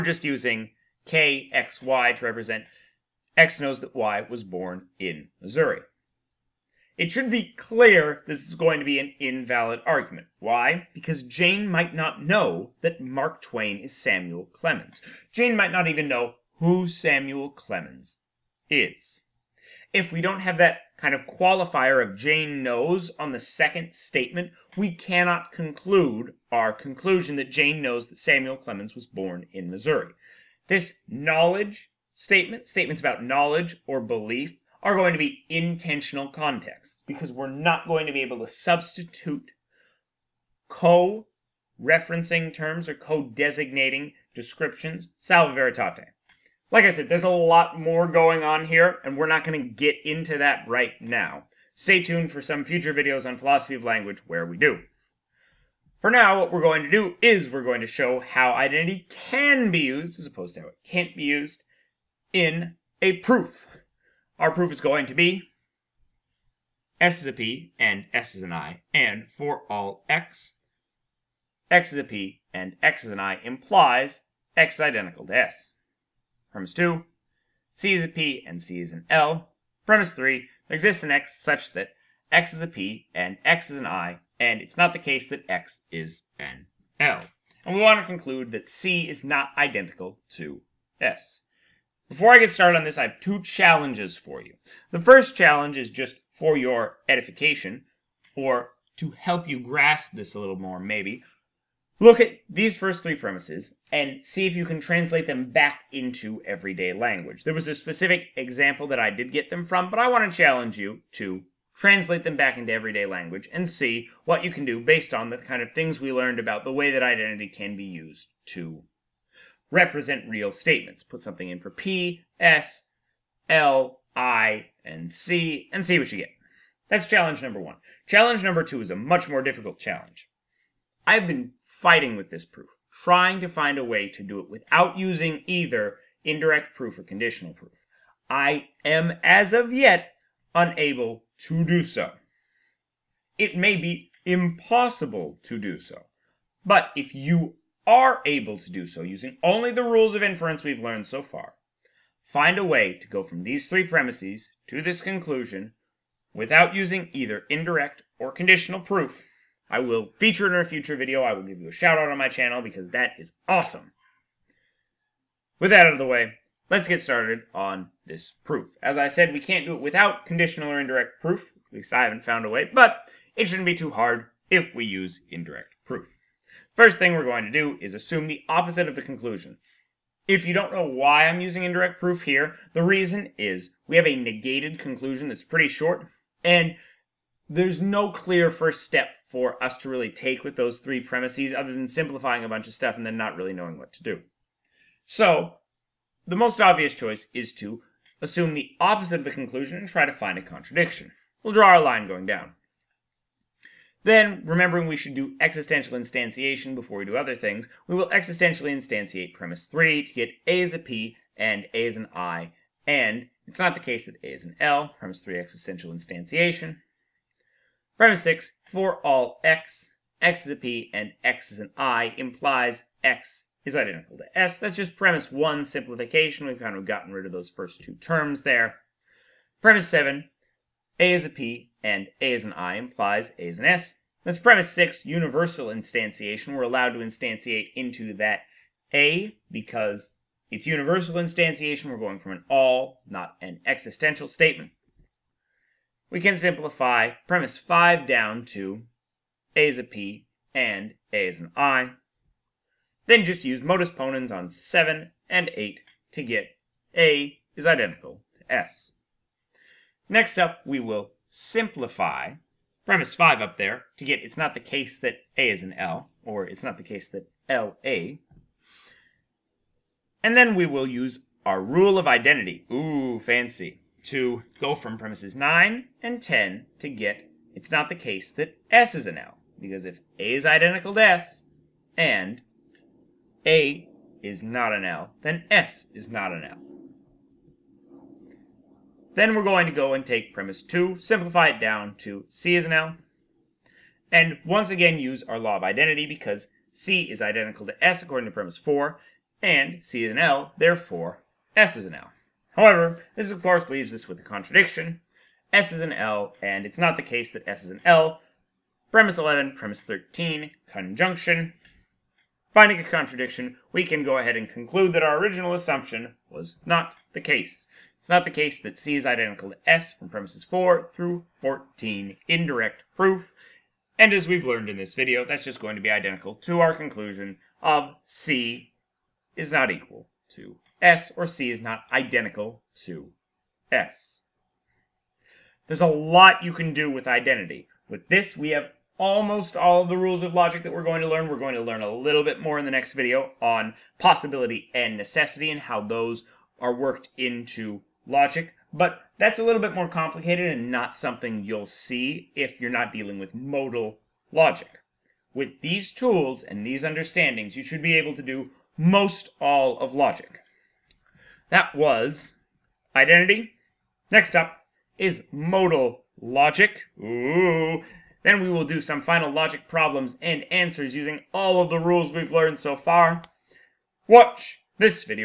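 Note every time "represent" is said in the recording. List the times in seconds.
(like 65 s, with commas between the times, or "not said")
2 s, 119 s.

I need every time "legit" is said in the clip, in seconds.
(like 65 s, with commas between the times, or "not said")
not said.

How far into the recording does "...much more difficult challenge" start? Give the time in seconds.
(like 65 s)
128 s.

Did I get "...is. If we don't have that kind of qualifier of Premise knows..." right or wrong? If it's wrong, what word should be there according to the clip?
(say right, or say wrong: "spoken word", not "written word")
wrong: "Jane", not "Premise".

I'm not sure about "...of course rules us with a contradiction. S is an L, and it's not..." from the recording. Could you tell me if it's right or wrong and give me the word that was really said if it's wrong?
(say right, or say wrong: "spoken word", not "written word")
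wrong: "leaves", not "rules".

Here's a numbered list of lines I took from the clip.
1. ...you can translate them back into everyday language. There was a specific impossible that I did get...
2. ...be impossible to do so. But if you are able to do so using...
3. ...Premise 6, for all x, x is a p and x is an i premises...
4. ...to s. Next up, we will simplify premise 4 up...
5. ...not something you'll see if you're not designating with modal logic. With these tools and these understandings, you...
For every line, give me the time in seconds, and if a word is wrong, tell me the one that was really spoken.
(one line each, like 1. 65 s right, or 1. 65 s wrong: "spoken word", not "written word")
1. 104 s wrong: "example", not "impossible"
2. 143 s right
3. 217 s wrong: "implies", not "premises"
4. 258 s wrong: "5", not "4"
5. 350 s wrong: "dealing", not "designating".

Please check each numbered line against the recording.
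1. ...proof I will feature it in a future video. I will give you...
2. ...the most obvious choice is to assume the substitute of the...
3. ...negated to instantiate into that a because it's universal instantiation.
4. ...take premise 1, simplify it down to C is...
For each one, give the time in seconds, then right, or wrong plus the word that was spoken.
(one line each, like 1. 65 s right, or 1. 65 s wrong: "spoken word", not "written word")
1. 158 s right
2. 196 s wrong: "opposite", not "substitute"
3. 236 s wrong: "allowed", not "negated"
4. 290 s wrong: "2", not "1".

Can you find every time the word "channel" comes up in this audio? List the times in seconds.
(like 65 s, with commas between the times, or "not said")
162 s.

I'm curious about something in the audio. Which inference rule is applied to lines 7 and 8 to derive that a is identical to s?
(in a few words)
modus ponens.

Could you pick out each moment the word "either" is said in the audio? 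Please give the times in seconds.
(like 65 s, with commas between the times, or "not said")
135 s, 157 s.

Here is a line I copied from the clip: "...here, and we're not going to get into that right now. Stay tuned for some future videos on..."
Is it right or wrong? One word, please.
right.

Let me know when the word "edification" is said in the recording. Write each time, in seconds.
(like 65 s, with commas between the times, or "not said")
97 s.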